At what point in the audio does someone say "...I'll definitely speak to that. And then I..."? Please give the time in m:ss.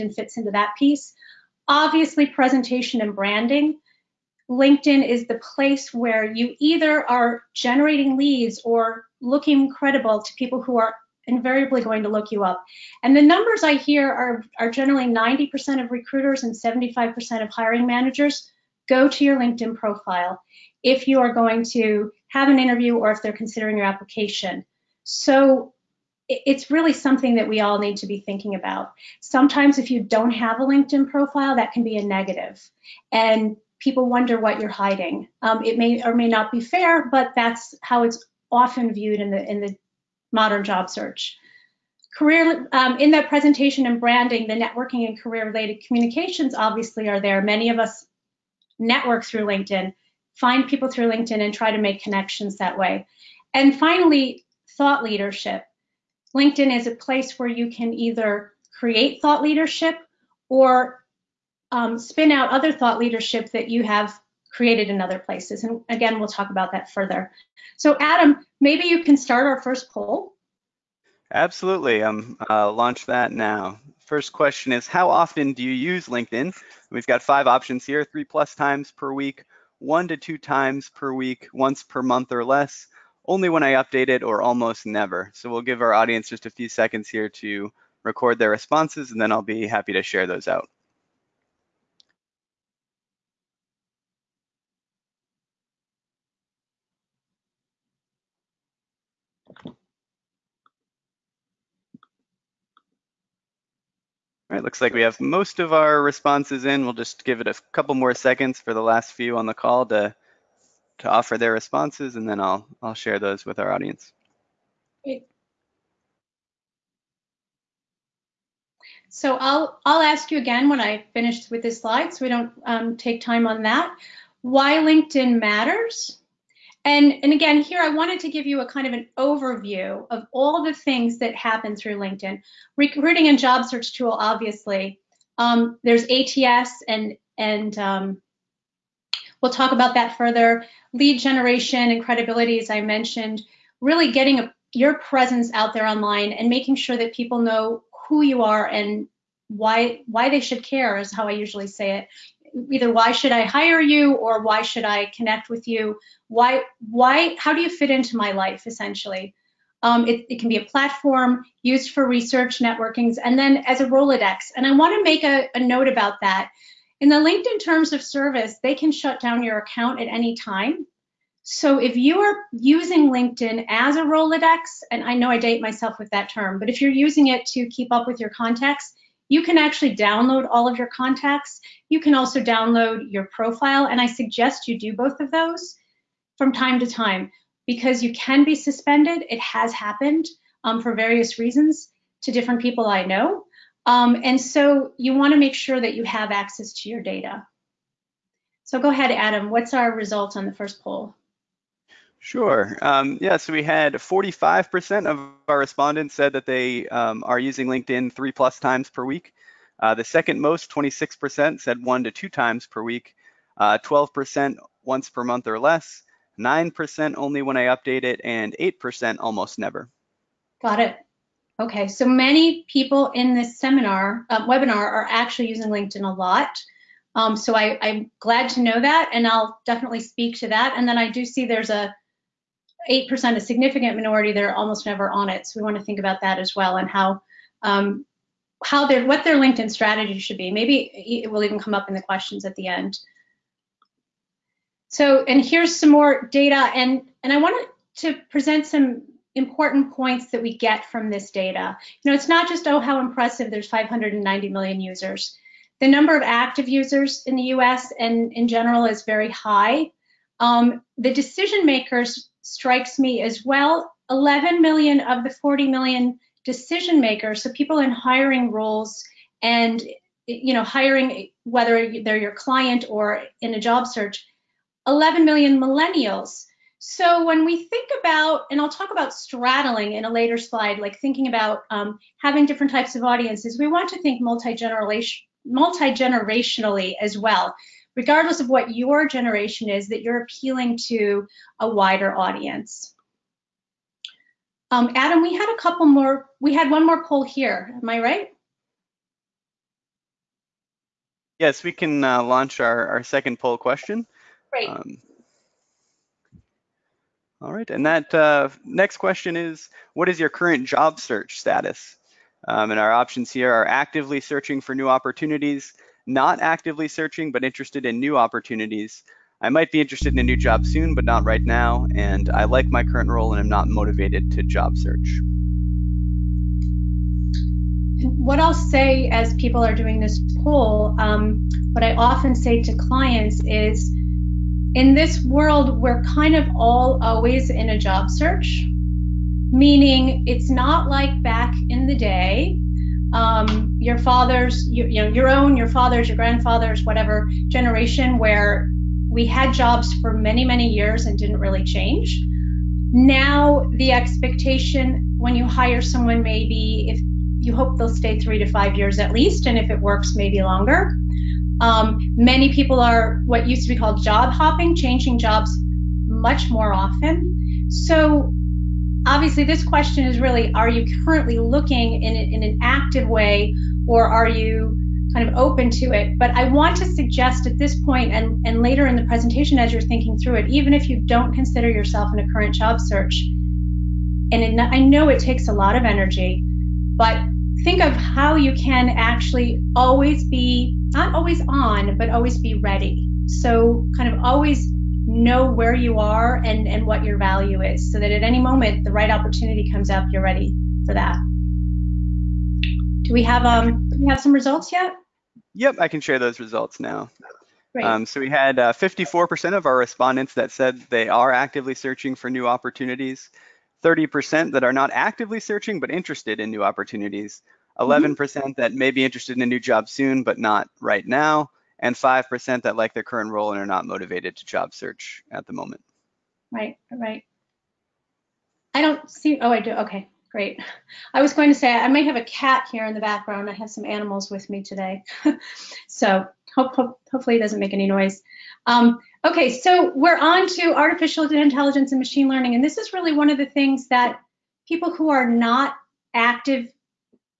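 3:49.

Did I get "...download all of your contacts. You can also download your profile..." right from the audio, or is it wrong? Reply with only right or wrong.
right.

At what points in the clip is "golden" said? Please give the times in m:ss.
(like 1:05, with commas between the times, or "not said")
not said.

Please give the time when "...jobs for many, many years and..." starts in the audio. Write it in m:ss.
5:49.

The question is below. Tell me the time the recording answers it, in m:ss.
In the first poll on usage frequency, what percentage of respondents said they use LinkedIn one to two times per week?
3:30.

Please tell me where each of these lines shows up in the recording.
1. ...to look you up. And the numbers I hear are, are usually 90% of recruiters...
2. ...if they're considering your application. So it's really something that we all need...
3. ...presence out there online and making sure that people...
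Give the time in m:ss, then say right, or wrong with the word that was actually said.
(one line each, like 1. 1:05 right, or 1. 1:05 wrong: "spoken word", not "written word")
1. 0:12 wrong: "generally", not "usually"
2. 0:23 right
3. 2:24 right.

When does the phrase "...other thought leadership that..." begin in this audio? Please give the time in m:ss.
1:02.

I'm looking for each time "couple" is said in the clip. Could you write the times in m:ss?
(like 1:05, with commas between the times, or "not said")
1:47, 4:55.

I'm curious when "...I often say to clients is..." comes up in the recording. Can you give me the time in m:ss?
5:31.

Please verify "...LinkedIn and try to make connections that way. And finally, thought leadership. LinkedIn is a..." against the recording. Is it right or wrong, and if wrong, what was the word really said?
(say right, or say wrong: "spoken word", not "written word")
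right.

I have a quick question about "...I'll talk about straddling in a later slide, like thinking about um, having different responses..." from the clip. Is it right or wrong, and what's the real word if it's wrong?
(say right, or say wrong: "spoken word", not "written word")
wrong: "types", not "responses".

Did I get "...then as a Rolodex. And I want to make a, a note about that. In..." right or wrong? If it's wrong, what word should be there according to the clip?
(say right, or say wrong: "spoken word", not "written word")
right.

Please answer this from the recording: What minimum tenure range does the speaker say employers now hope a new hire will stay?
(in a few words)
3 to 5 years.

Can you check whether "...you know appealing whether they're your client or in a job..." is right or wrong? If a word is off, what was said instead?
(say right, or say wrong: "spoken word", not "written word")
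wrong: "hiring", not "appealing".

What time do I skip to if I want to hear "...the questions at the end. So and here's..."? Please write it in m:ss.
4:01.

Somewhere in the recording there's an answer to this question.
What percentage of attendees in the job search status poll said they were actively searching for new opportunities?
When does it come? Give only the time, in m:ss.
6:48.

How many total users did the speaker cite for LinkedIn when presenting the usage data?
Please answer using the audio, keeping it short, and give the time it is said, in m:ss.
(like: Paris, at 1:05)
590 million, at 4:13.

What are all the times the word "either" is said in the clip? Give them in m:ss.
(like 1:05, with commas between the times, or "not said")
0:06, 0:57, 2:32.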